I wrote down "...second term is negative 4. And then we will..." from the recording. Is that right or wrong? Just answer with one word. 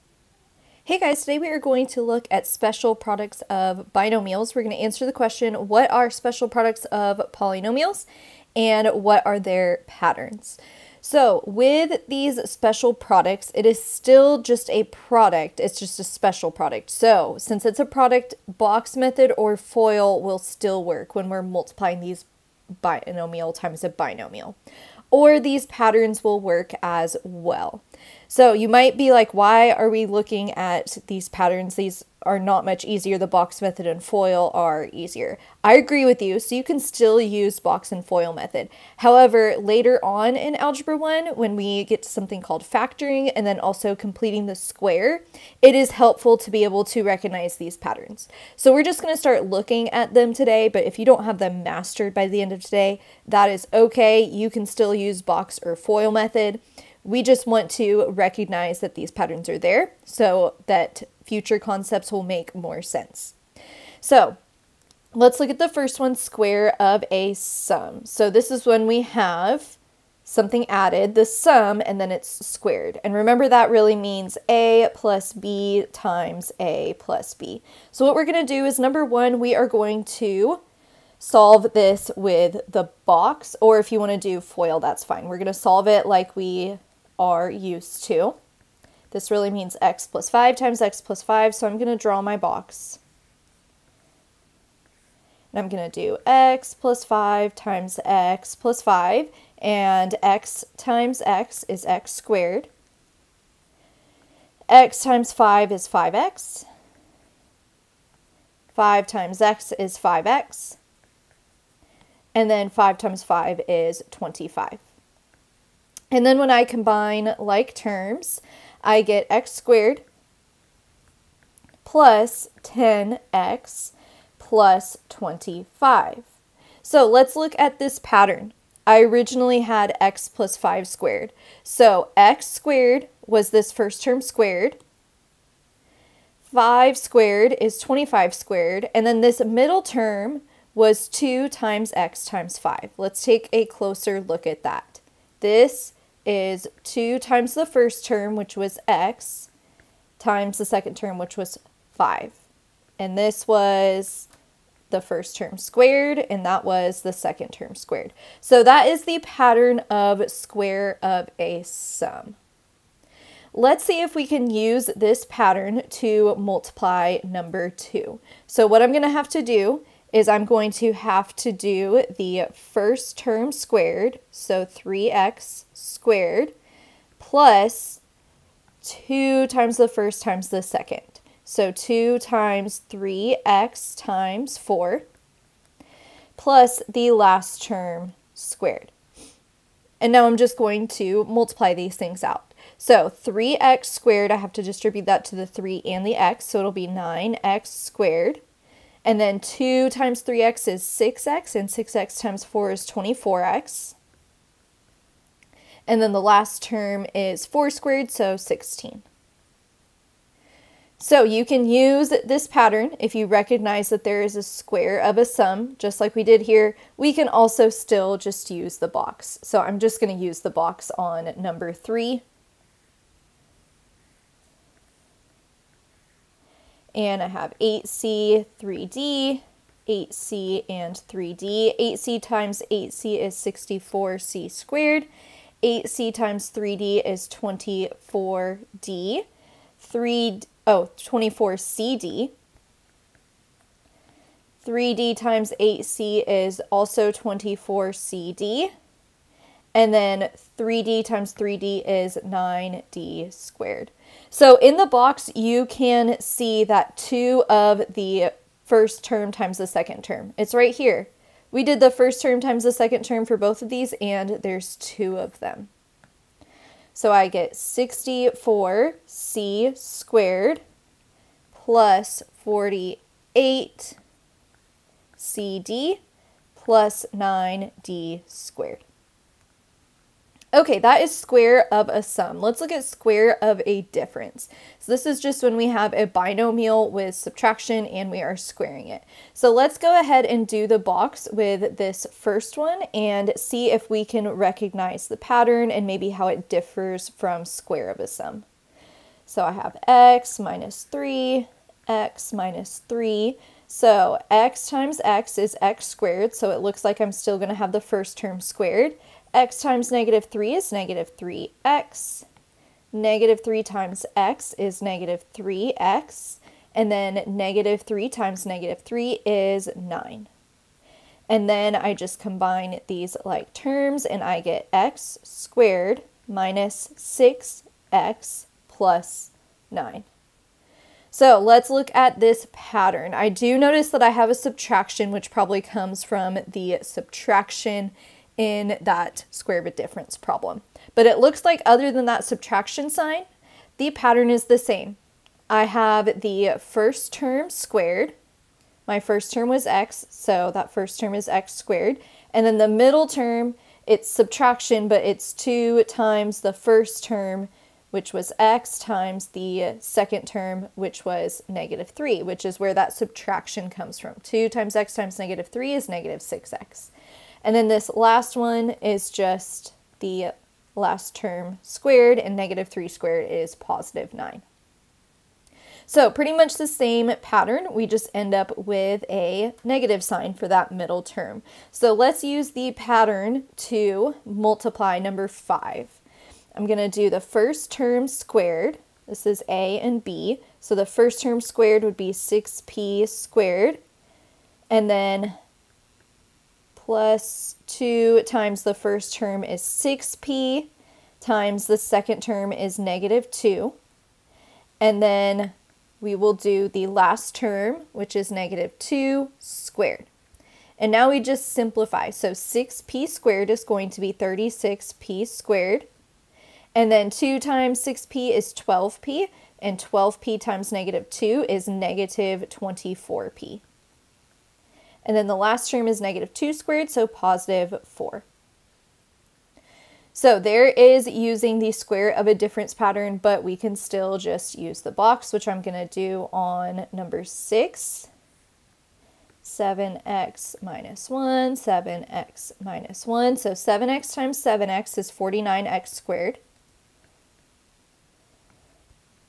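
wrong.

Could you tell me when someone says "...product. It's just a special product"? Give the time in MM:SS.
00:14.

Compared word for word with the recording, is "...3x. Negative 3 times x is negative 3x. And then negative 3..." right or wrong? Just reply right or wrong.
right.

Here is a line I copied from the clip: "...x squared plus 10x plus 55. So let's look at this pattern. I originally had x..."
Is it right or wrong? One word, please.
wrong.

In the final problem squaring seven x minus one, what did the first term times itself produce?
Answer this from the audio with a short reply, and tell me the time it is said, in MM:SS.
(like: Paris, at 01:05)
49x squared, at 07:25.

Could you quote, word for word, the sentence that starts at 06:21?
So let's use the pattern to multiply number 5.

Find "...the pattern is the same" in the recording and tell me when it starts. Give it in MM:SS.
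05:43.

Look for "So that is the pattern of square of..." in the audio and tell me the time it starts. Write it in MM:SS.
02:38.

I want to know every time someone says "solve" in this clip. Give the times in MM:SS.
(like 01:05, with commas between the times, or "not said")
01:21, 01:25.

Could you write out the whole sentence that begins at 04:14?
So in the box, you can see that two of the first term times the second term.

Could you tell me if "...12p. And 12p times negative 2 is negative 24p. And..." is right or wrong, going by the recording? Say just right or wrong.
right.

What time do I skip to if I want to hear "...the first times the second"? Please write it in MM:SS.
02:59.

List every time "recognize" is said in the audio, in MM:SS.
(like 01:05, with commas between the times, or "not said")
00:47, 00:58, 03:33, 04:54.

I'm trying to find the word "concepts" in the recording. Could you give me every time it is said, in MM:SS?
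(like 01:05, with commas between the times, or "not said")
01:01.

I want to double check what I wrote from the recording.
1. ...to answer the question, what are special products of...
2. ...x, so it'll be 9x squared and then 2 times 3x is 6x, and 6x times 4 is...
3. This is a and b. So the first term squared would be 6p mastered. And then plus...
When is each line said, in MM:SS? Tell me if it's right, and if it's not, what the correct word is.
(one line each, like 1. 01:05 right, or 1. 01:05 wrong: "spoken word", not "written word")
1. 00:04 right
2. 03:16 right
3. 06:29 wrong: "squared", not "mastered".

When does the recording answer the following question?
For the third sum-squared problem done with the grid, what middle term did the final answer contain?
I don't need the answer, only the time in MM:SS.
04:32.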